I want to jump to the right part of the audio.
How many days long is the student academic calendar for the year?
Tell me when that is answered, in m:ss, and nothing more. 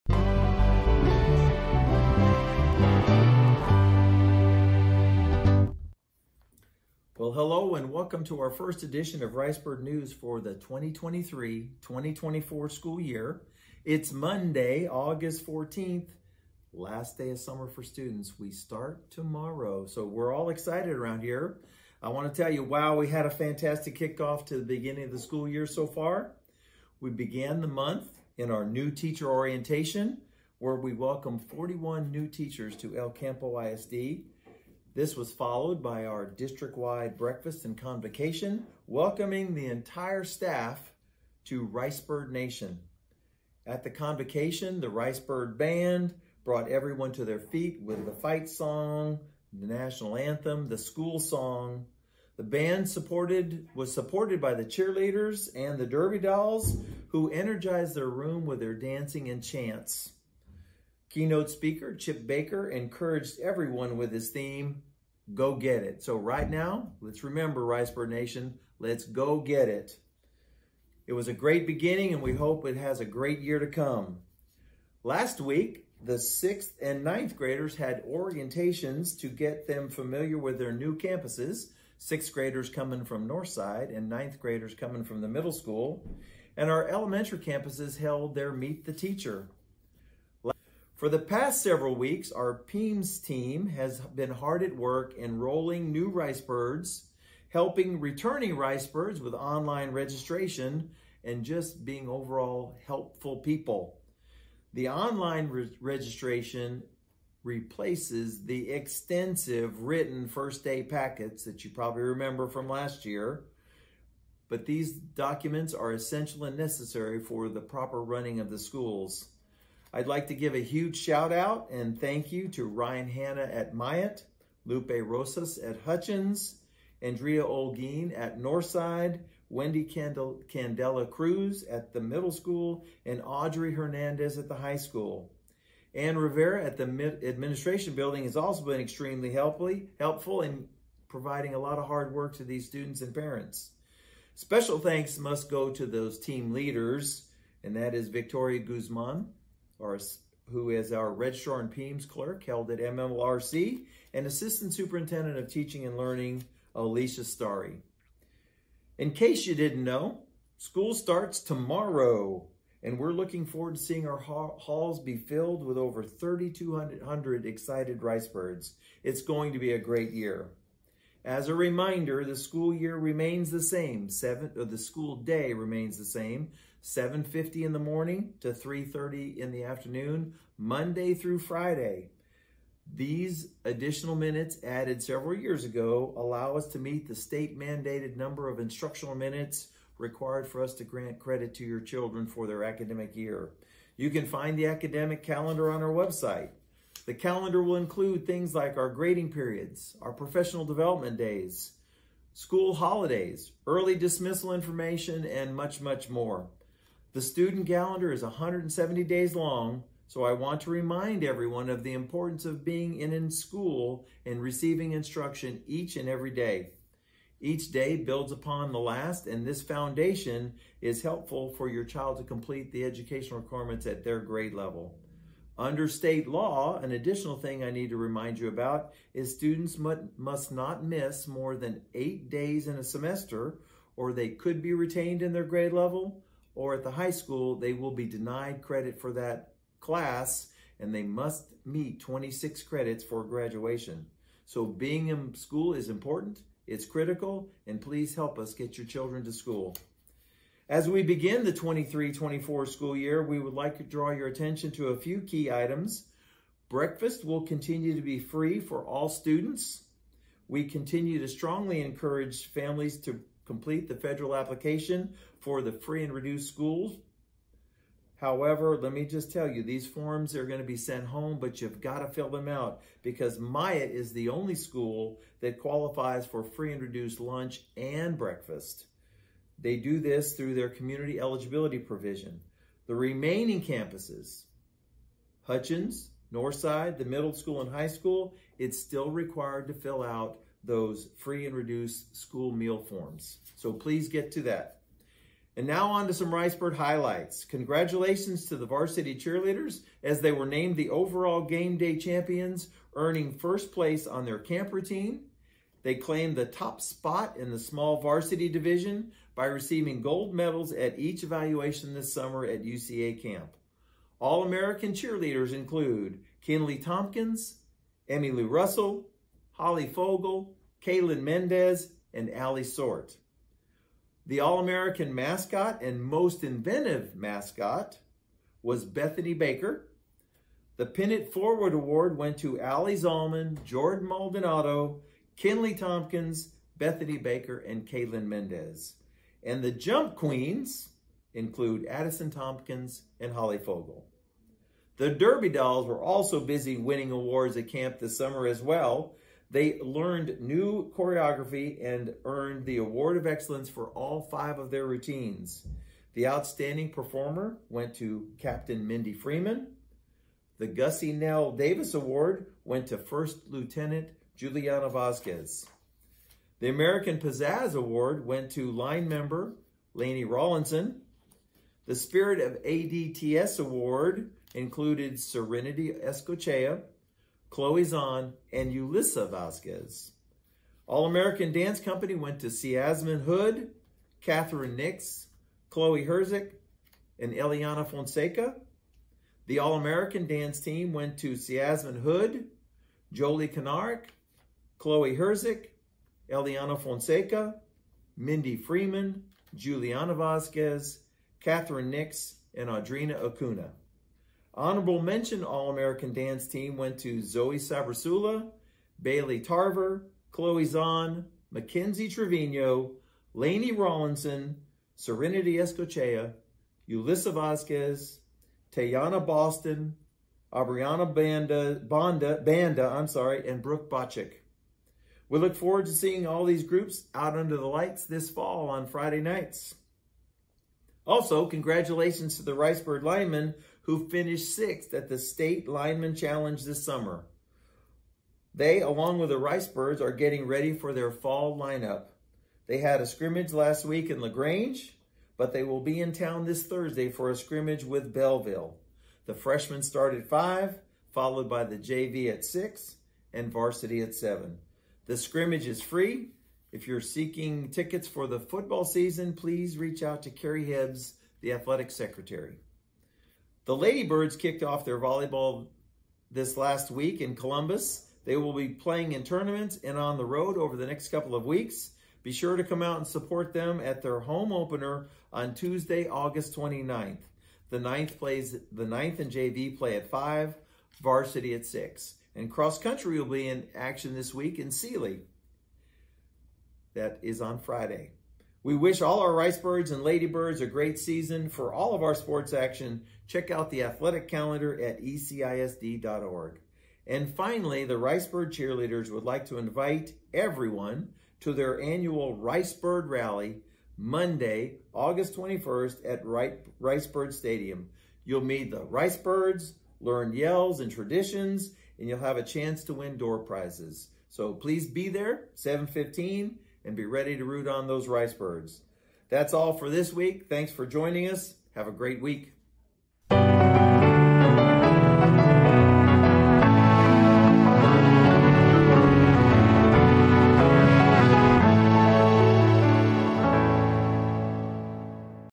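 3:28.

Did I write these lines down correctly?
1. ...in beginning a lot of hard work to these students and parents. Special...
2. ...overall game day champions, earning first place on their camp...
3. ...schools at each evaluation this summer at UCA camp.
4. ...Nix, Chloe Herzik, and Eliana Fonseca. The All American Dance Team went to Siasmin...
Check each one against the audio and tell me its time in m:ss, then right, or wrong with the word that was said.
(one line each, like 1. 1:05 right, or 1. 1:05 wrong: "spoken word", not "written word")
1. 2:20 wrong: "providing", not "beginning"
2. 5:00 right
3. 5:10 wrong: "medals", not "schools"
4. 6:24 right.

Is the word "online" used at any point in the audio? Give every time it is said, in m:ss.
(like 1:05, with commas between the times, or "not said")
1:39, 1:44.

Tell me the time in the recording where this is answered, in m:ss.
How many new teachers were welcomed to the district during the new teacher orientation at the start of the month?
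0:31.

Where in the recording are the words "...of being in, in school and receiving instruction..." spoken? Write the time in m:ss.
3:32.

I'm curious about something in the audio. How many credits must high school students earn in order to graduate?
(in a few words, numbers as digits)
26.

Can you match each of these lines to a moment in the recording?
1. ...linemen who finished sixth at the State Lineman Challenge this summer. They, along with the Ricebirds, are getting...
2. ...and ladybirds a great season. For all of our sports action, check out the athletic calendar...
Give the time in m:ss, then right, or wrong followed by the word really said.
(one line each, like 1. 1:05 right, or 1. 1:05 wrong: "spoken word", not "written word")
1. 7:13 right
2. 8:09 right.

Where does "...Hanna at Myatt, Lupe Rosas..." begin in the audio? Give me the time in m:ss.
2:03.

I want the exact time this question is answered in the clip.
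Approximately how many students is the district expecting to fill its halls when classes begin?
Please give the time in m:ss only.
2:46.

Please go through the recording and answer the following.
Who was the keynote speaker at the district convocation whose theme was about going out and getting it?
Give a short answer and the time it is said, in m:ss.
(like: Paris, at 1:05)
Chip Baker, at 1:01.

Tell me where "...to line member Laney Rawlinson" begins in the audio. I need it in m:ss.
6:08.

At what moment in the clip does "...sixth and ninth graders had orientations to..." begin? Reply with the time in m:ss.
1:16.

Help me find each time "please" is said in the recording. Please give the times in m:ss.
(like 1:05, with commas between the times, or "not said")
4:07, 4:53, 7:39, 8:34.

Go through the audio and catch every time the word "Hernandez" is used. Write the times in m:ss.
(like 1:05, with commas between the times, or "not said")
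2:13.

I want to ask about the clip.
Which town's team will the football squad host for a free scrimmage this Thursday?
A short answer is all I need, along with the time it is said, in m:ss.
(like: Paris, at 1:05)
Bellville, at 7:28.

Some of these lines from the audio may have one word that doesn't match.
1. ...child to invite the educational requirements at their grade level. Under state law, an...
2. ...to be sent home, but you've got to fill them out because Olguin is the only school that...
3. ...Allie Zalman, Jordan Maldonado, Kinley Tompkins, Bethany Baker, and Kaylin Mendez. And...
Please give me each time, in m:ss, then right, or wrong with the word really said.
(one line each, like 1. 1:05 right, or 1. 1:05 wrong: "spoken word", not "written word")
1. 3:41 wrong: "complete", not "invite"
2. 4:30 wrong: "Myatt", not "Olguin"
3. 5:32 right.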